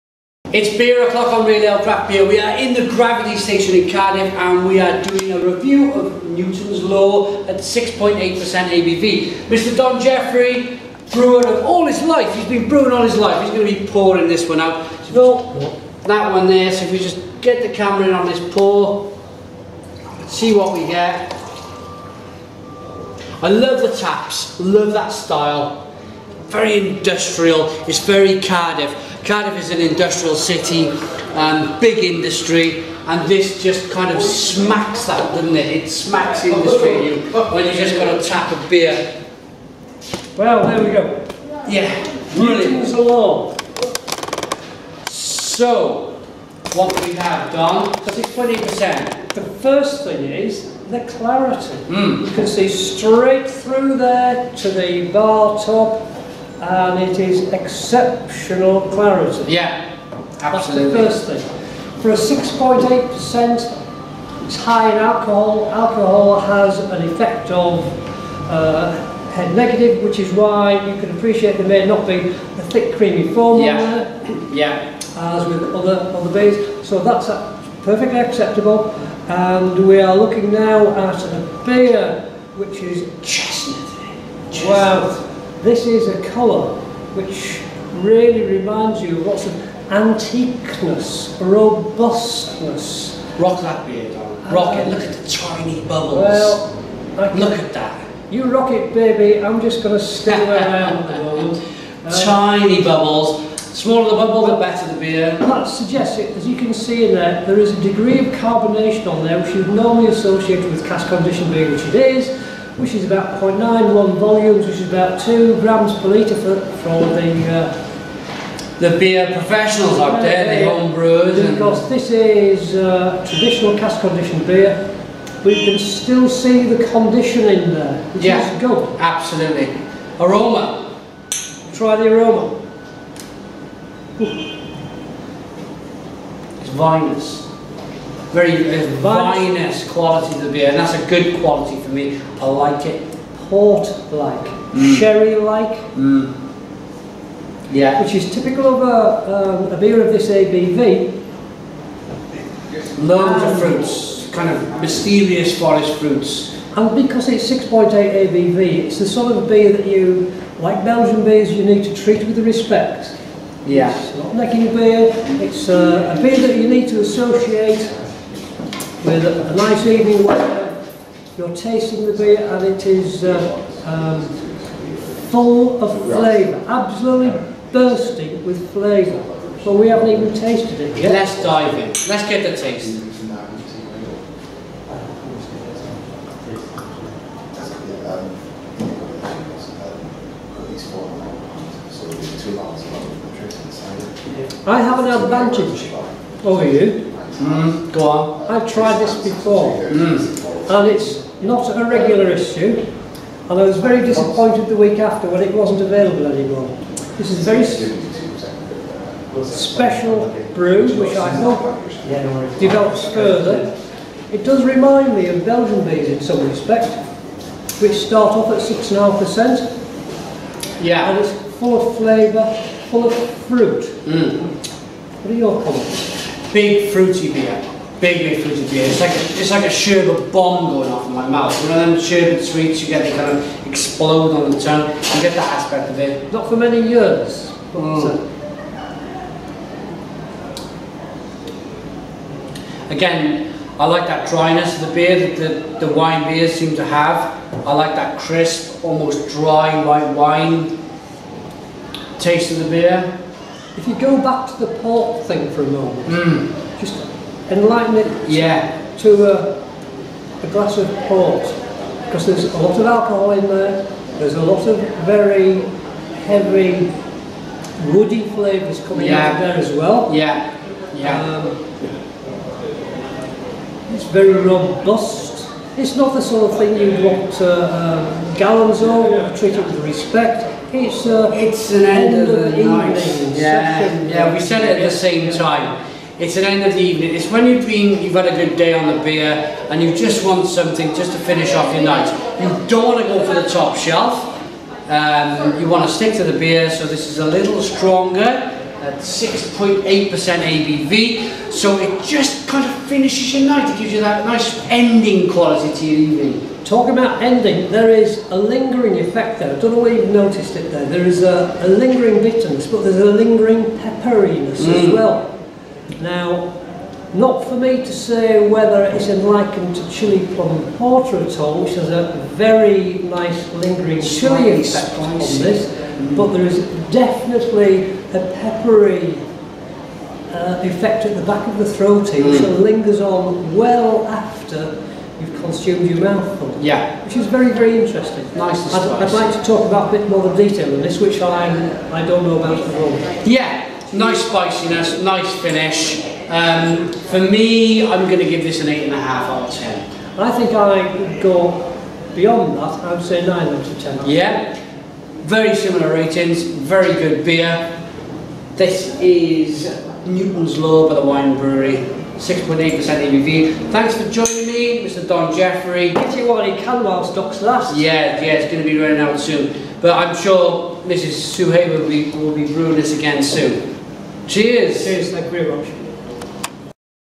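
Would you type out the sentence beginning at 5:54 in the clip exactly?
yeah, very similar ratings, very good beer.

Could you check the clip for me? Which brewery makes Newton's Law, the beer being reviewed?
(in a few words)
Waen Brewery.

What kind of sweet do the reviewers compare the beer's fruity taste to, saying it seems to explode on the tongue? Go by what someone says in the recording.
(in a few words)
Sherbet bomb.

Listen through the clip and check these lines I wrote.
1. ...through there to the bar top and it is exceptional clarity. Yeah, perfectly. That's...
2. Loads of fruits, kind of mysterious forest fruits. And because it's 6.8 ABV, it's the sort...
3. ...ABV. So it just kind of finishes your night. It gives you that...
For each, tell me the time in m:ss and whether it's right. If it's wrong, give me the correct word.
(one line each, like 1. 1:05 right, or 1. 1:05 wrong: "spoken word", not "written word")
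1. 0:53 wrong: "absolutely", not "perfectly"
2. 2:33 right
3. 5:00 right.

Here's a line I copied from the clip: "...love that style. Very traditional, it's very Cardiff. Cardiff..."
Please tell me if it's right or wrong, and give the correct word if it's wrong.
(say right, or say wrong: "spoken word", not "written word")
wrong: "industrial", not "traditional".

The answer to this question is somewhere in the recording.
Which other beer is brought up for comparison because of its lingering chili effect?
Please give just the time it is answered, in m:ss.
5:19.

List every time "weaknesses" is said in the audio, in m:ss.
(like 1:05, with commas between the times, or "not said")
not said.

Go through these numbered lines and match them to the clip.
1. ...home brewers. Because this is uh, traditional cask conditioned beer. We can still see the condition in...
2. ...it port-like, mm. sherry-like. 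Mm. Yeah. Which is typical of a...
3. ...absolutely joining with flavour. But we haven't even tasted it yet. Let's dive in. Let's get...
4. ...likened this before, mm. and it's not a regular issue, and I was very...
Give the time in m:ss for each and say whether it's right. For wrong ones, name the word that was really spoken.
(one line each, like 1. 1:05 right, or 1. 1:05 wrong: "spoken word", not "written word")
1. 2:00 right
2. 2:22 right
3. 2:56 wrong: "bursting", not "joining"
4. 3:18 wrong: "tried", not "likened".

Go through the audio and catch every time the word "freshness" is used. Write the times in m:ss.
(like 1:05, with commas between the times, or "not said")
not said.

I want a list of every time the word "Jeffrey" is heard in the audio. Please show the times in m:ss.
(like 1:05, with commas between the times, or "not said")
0:10, 6:05.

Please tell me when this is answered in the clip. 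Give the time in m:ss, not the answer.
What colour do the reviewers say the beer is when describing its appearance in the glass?
1:23.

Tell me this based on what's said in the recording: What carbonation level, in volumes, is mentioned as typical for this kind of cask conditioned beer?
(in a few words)
0.91 volumes.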